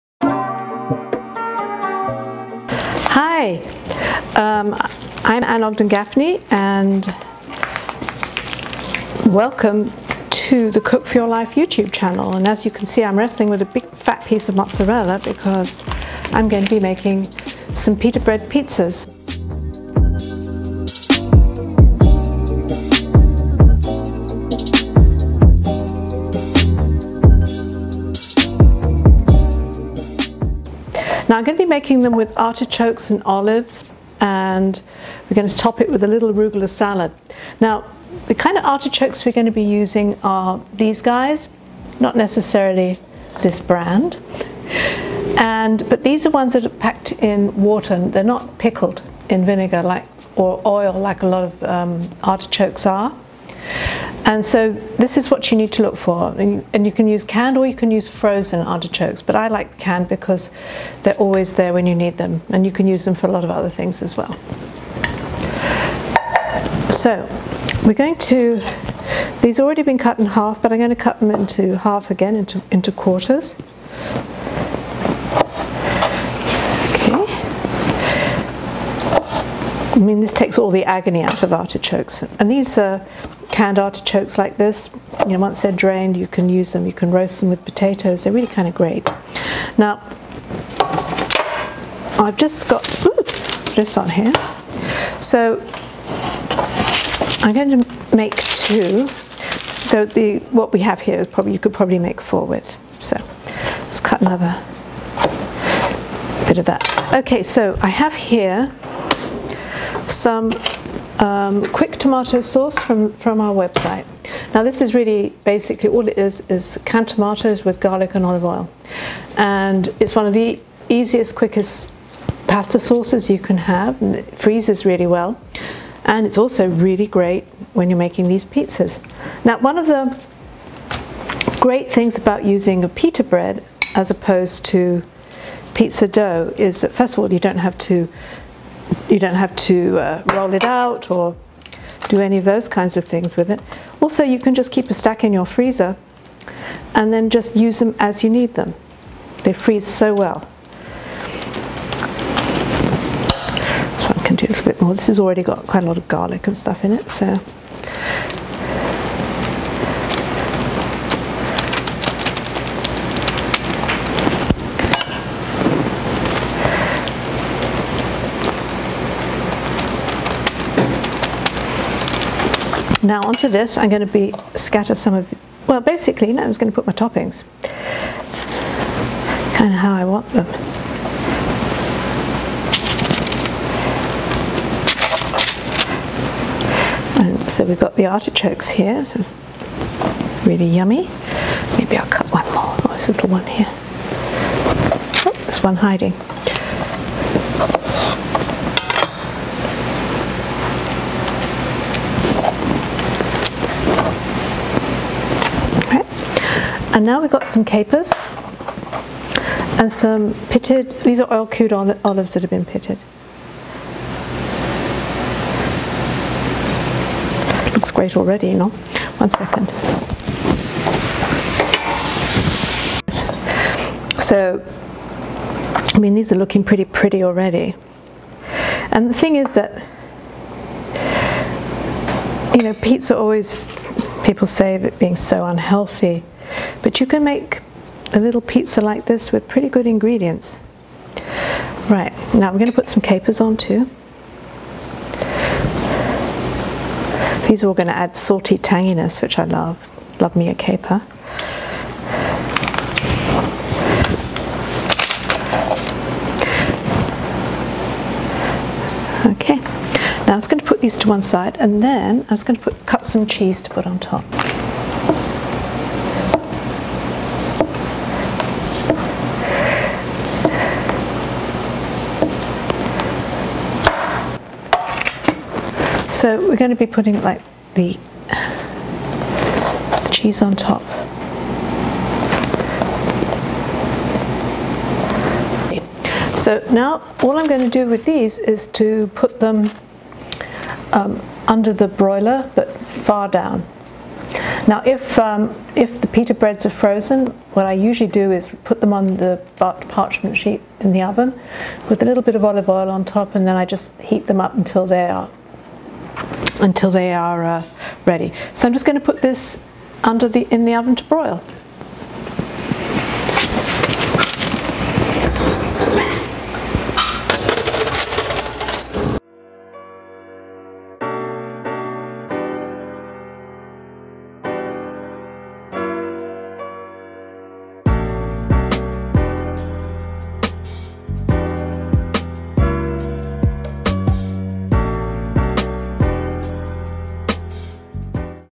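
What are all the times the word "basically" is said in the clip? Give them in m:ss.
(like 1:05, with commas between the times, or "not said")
1:55, 2:55.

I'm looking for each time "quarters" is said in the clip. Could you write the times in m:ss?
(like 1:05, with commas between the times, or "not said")
1:12.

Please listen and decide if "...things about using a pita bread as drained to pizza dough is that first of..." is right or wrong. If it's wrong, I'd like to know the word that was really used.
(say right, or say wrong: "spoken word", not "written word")
wrong: "opposed", not "drained".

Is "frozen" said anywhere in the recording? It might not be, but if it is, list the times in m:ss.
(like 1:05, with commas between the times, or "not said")
0:58, 4:56.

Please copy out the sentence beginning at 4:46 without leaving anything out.
So now all I'm going to do with these is to put them um, under the broiler but far down.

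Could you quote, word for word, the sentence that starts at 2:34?
So I can do a little bit more.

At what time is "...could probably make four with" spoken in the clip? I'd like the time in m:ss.
1:41.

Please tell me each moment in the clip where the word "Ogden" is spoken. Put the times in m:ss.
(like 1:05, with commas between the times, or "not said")
0:05.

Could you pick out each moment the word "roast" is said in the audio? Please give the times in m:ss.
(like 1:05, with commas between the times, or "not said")
1:27.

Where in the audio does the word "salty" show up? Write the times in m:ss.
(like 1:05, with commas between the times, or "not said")
4:08.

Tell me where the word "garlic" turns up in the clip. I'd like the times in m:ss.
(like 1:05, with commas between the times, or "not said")
1:57, 2:36.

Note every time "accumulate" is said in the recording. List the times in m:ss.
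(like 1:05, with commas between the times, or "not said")
not said.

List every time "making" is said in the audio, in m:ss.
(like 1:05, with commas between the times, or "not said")
0:16, 0:31, 2:07.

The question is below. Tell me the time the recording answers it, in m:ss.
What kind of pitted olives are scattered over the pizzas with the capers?
3:31.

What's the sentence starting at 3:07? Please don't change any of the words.
And so we've got the artichokes here, really yummy.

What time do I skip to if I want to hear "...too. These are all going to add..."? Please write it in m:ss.
4:03.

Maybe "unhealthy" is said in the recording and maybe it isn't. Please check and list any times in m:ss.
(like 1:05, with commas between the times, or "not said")
3:55.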